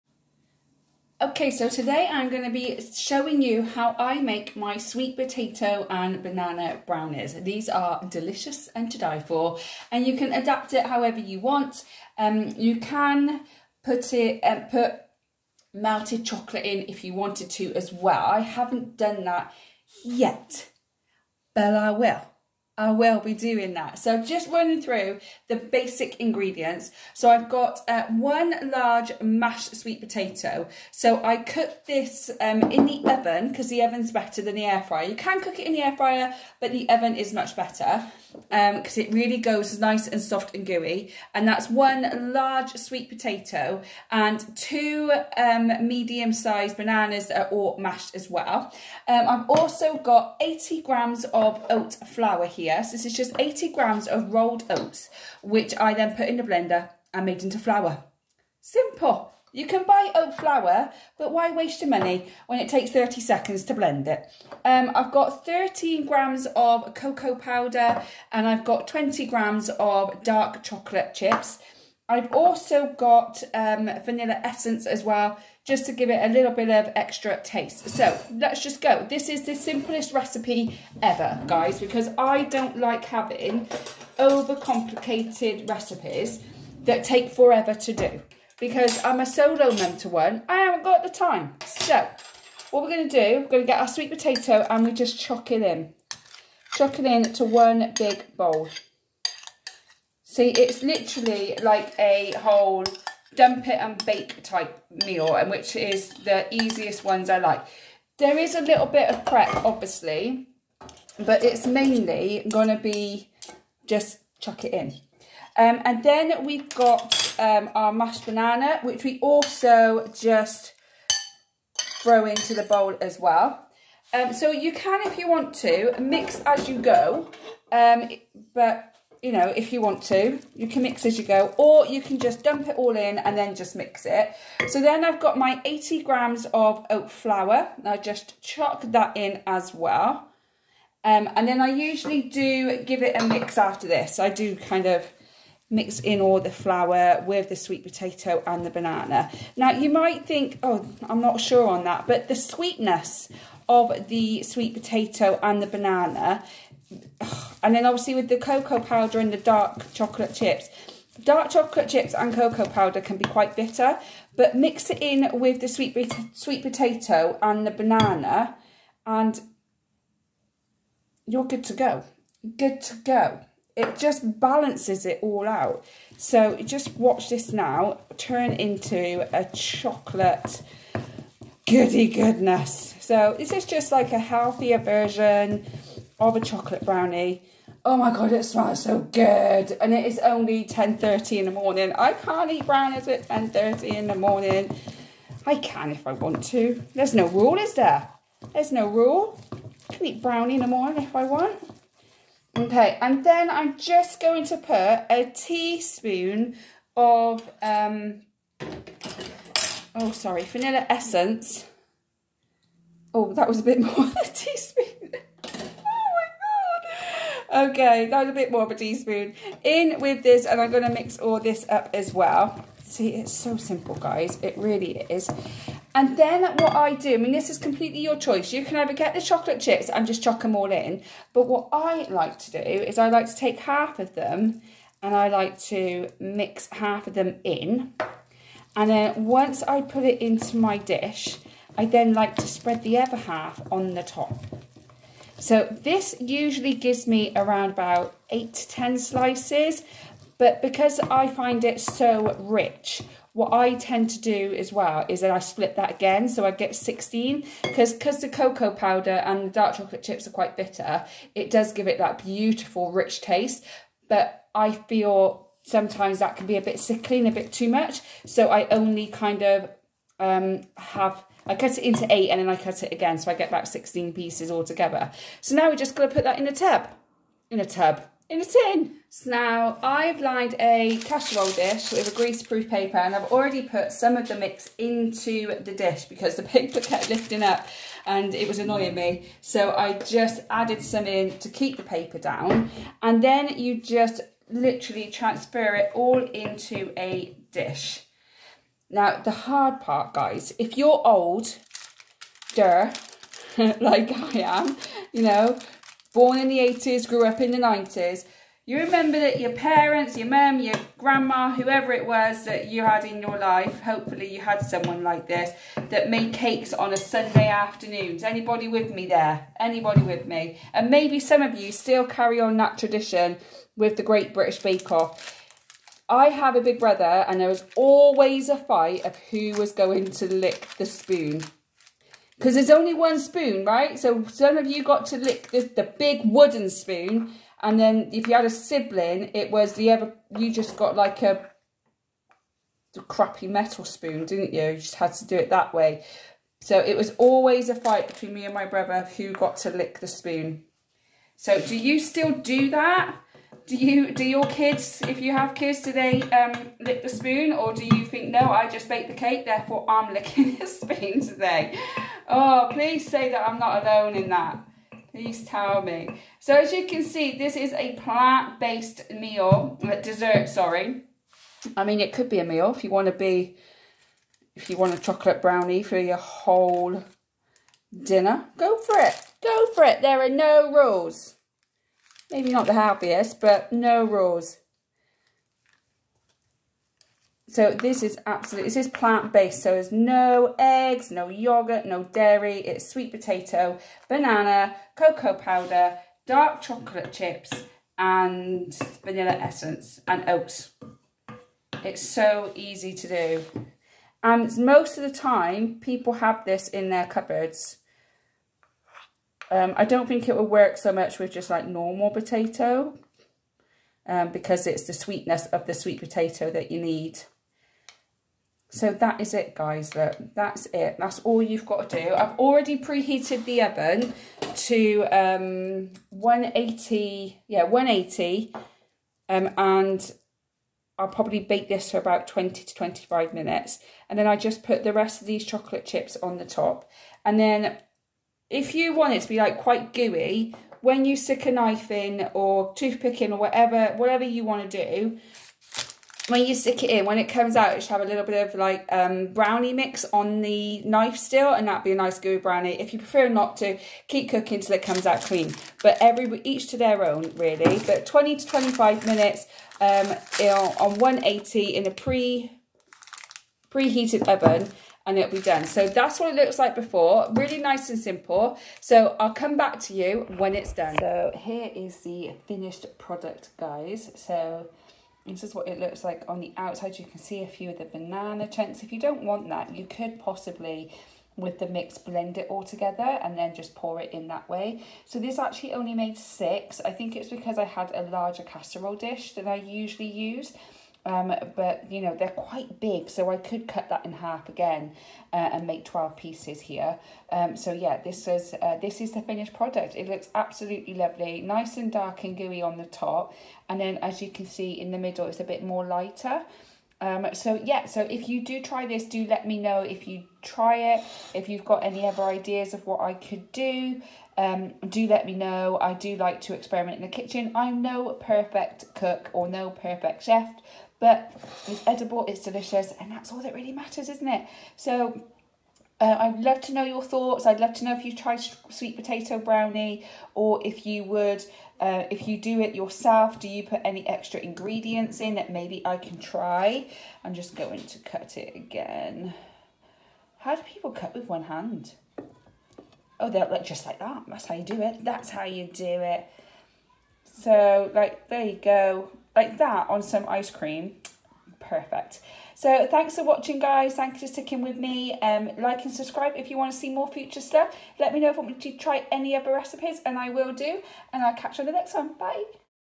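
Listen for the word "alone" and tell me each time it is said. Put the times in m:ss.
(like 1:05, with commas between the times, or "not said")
6:03.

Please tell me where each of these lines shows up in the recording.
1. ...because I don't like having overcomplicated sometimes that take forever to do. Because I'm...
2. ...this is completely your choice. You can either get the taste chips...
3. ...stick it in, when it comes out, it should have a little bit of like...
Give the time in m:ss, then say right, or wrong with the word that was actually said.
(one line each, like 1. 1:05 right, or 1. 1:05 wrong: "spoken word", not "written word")
1. 1:21 wrong: "recipes", not "sometimes"
2. 3:47 wrong: "chocolate", not "taste"
3. 7:26 right.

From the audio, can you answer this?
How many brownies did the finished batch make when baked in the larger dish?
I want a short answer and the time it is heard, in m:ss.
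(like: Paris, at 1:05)
6, at 8:06.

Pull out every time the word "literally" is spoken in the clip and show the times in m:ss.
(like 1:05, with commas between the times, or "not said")
1:40, 4:54.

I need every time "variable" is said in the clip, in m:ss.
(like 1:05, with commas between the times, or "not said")
not said.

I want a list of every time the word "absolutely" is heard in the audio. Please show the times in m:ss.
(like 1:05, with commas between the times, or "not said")
6:28, 8:20.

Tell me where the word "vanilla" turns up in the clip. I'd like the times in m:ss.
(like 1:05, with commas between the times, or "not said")
1:14, 3:30, 6:39.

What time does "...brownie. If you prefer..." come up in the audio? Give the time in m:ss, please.
7:32.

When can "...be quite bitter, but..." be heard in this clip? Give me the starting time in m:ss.
2:43.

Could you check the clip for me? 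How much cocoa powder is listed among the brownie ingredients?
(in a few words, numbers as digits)
13 grams.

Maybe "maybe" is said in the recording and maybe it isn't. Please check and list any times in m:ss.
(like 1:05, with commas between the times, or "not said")
5:20, 6:22, 8:55.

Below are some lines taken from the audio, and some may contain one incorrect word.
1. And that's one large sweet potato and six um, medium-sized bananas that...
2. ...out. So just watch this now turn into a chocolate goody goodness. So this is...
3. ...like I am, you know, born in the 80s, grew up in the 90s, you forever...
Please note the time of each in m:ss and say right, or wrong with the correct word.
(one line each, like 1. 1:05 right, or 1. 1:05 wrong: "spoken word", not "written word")
1. 0:41 wrong: "two", not "six"
2. 2:55 right
3. 5:02 wrong: "remember", not "forever".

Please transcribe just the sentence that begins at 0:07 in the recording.
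These are delicious and to die for, and you can adapt it however you want.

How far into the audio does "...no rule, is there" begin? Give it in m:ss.
3:17.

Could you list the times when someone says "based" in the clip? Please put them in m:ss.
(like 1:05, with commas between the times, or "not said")
6:07, 6:28.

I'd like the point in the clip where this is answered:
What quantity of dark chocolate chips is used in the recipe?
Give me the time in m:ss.
1:08.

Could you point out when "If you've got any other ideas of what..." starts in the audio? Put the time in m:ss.
8:31.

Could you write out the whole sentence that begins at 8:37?
I'm no perfect cook or no perfect chef, but it's edible, it's delicious, and that's all that really matters, isn't it?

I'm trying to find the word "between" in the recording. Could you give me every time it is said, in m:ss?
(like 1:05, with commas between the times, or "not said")
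5:48.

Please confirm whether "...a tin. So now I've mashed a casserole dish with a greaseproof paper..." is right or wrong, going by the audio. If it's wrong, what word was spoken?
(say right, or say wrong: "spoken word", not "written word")
wrong: "lined", not "mashed".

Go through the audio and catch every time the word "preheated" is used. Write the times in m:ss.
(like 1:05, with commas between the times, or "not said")
7:02, 7:43.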